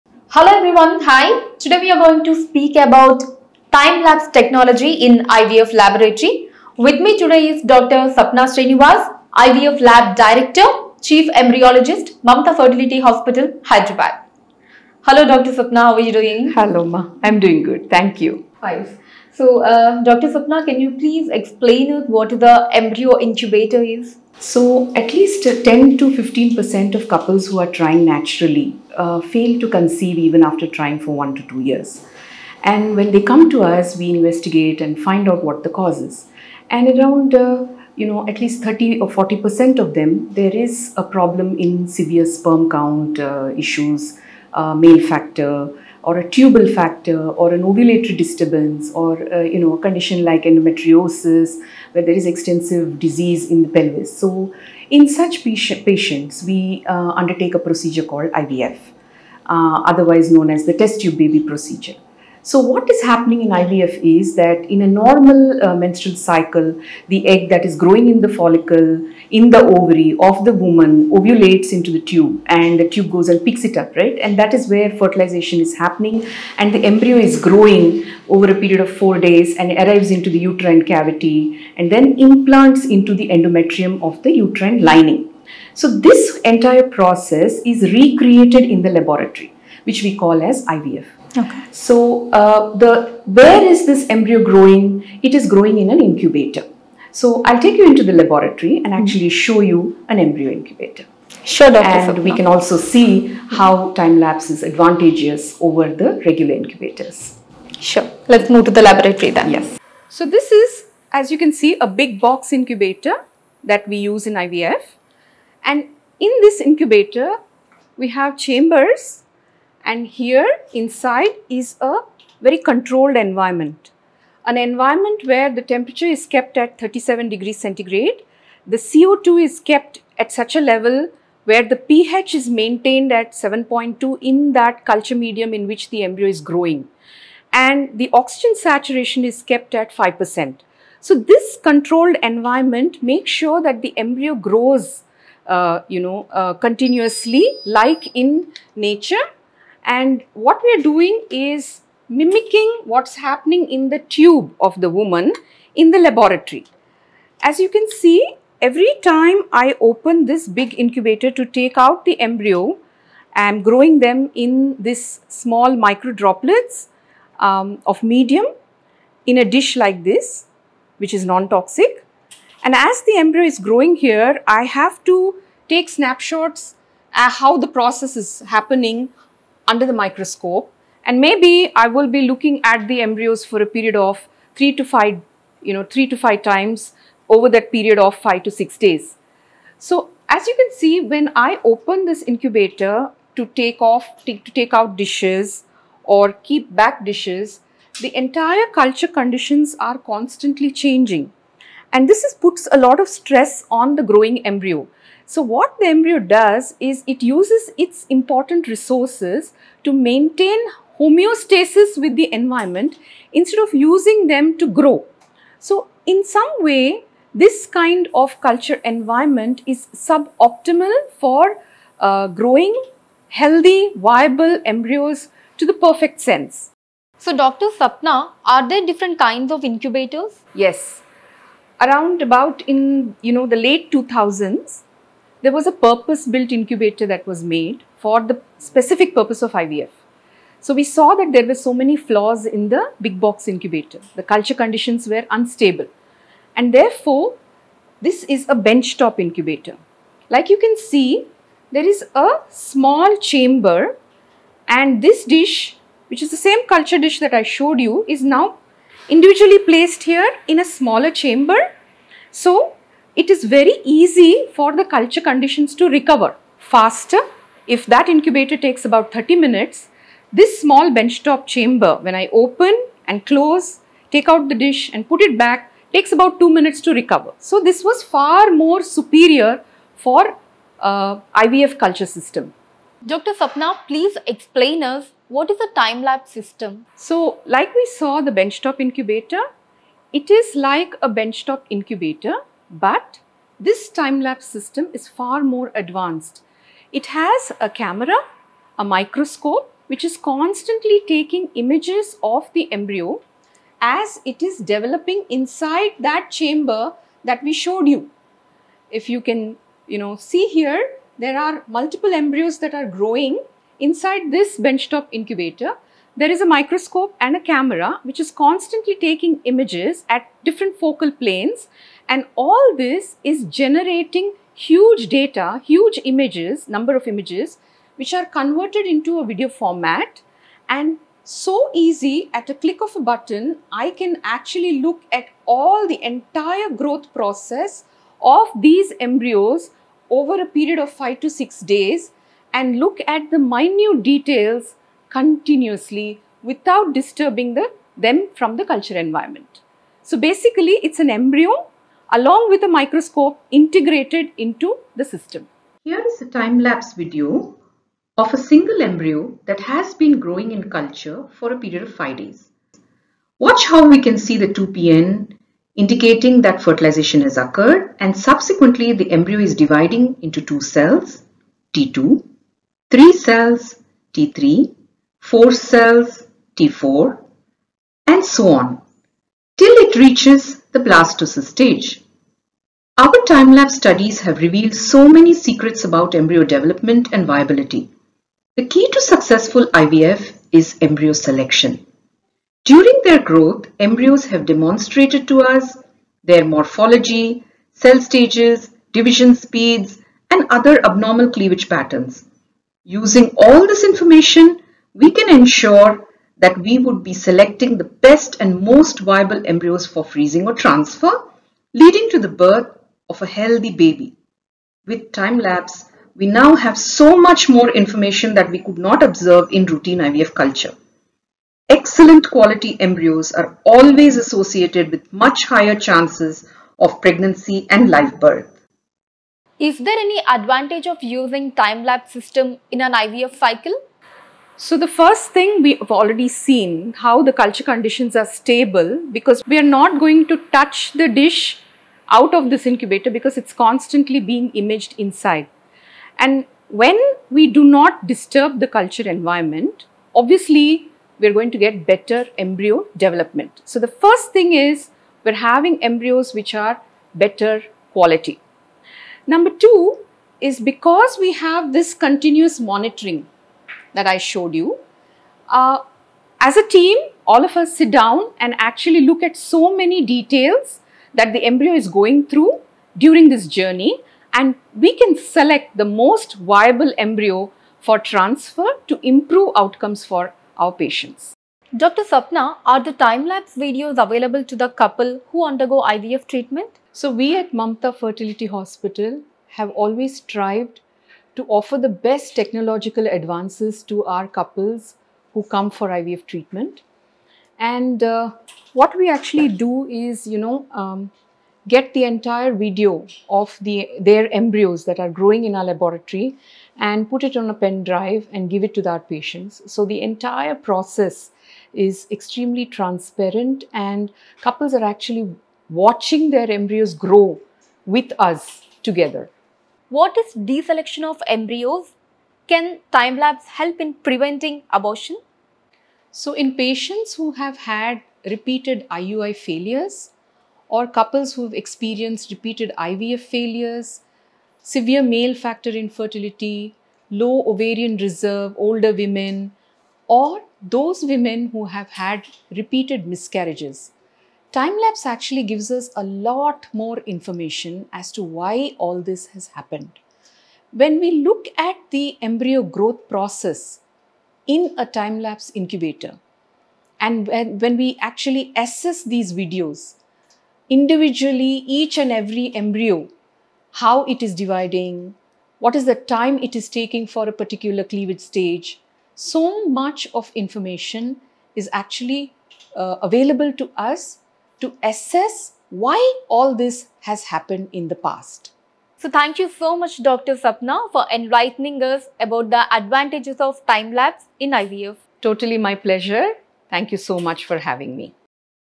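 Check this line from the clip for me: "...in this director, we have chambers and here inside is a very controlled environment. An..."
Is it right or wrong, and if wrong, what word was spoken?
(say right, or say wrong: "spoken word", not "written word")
wrong: "incubator", not "director".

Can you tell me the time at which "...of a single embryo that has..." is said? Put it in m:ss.
5:58.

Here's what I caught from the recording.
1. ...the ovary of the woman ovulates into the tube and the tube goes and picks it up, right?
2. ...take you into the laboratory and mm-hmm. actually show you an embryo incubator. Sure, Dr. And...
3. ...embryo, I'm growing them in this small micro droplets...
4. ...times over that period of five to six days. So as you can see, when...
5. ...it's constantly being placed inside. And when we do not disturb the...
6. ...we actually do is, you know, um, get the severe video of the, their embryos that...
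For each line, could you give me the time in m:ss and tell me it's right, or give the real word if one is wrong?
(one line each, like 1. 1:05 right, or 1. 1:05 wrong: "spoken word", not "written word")
1. 1:09 right
2. 1:37 right
3. 2:42 right
4. 3:06 right
5. 7:23 wrong: "imaged", not "placed"
6. 8:18 wrong: "entire", not "severe".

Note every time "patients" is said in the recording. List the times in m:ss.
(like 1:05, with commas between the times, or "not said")
0:55, 8:00, 8:28, 8:46.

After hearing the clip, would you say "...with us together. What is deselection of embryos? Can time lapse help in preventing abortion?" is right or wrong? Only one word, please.
right.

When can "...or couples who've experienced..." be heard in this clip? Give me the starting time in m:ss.
8:50.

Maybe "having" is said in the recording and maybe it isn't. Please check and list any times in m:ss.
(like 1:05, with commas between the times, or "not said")
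7:35, 9:47.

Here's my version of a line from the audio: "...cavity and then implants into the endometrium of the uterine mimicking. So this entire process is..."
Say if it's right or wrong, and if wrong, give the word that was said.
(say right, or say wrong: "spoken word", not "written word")
wrong: "lining", not "mimicking".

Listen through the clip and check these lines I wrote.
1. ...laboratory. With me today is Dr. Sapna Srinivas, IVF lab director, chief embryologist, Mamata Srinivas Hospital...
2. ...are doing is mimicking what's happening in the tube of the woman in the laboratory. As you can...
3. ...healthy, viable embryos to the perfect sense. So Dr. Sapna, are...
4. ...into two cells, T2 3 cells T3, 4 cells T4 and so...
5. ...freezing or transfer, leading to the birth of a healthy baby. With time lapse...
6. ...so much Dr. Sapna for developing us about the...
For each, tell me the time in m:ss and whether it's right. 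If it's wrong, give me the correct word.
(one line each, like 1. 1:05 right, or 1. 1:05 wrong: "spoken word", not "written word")
1. 0:05 wrong: "Fertility", not "Srinivas"
2. 2:30 right
3. 3:43 right
4. 6:10 right
5. 6:50 right
6. 9:39 wrong: "enlightening", not "developing".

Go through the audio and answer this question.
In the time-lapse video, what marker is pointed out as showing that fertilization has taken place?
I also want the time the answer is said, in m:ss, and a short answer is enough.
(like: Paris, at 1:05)
2PN, at 6:04.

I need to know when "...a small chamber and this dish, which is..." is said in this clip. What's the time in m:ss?
4:12.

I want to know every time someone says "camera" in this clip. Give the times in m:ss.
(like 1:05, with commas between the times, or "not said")
4:57, 5:17.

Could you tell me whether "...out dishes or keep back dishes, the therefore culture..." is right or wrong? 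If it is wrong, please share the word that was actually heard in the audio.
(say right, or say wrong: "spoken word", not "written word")
wrong: "entire", not "therefore".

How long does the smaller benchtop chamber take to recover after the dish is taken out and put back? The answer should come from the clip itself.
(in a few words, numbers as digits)
2 minutes.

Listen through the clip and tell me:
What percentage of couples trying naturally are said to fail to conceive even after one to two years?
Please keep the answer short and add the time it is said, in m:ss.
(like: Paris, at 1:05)
10 to 15%, at 0:25.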